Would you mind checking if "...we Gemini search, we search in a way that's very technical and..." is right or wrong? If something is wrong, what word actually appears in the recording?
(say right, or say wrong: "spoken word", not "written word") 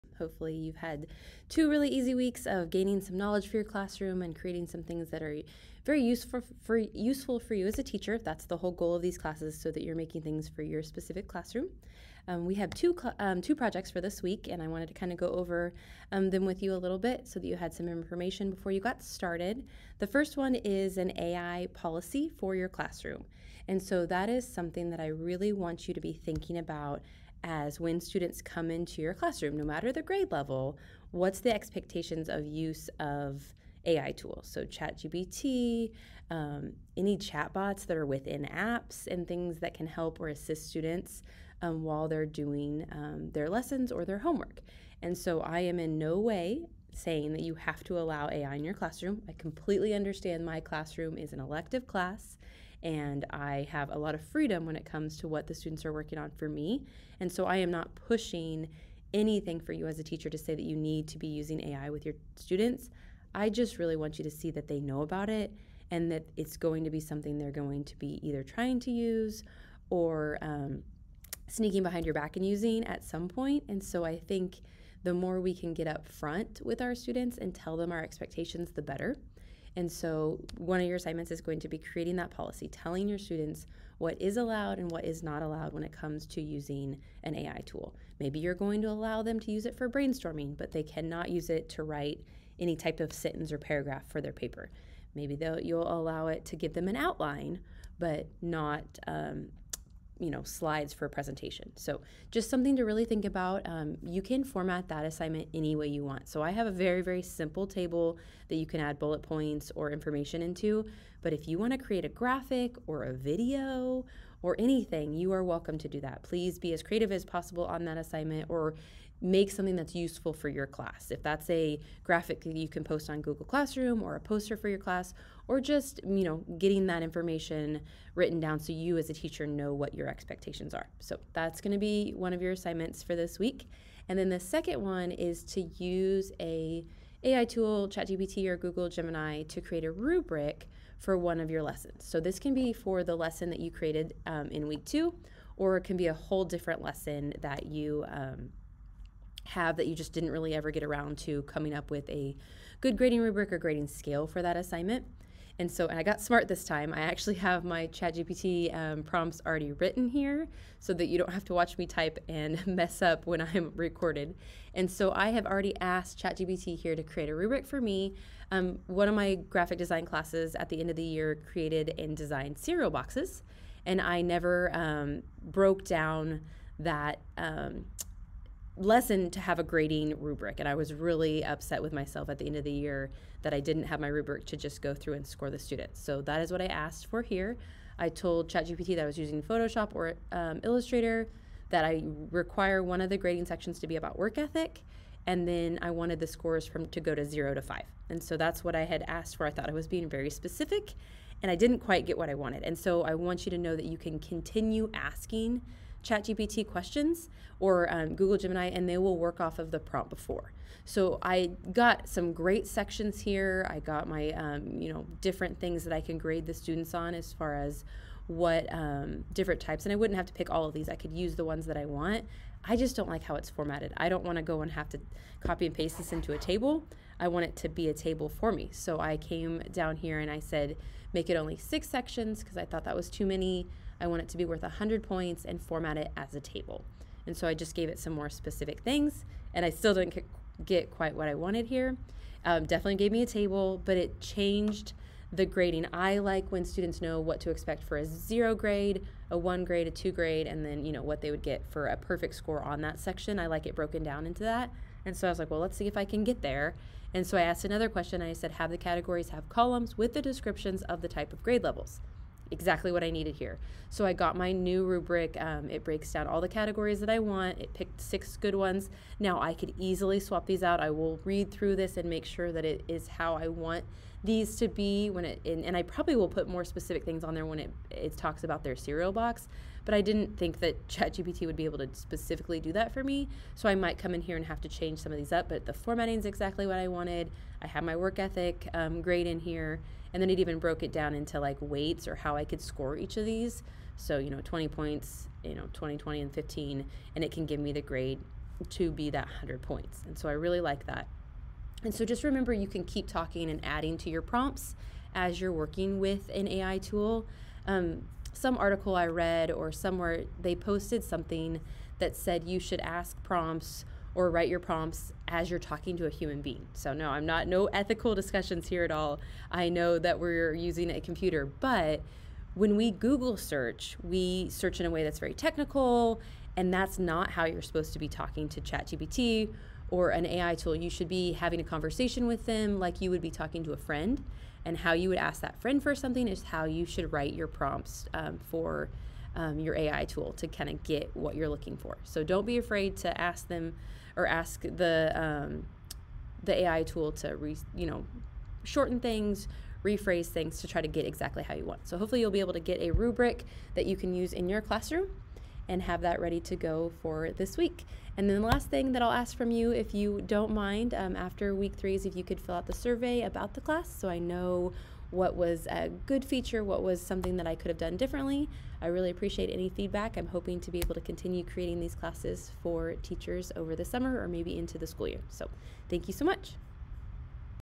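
wrong: "Google", not "Gemini".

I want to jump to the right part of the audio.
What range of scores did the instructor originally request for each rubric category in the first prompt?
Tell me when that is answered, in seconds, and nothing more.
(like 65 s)
197 s.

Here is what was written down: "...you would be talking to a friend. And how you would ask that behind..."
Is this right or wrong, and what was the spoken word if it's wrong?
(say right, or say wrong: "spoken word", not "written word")
wrong: "friend", not "behind".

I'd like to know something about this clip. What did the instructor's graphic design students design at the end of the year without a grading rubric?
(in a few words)
Cereal boxes.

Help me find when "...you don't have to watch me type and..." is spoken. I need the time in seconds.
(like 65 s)
161 s.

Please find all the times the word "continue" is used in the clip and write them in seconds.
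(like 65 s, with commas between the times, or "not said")
204 s, 371 s.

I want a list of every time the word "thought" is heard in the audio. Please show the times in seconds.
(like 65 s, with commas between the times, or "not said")
199 s, 232 s.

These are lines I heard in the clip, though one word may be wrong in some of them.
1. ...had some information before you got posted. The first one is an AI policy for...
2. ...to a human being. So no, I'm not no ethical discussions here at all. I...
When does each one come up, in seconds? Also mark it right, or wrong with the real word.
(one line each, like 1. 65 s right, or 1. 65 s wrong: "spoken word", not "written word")
1. 17 s wrong: "started", not "posted"
2. 315 s right.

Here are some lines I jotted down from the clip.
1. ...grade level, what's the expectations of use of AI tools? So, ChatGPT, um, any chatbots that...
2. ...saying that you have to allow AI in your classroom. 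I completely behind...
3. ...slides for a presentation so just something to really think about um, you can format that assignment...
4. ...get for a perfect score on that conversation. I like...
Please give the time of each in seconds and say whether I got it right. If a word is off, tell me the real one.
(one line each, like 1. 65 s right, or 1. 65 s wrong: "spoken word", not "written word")
1. 30 s right
2. 46 s wrong: "understand", not "behind"
3. 100 s right
4. 251 s wrong: "section", not "conversation".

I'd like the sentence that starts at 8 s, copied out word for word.
That's the whole goal of these classes, so that you're making things for your specific classroom.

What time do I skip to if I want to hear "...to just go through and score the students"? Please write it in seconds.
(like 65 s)
184 s.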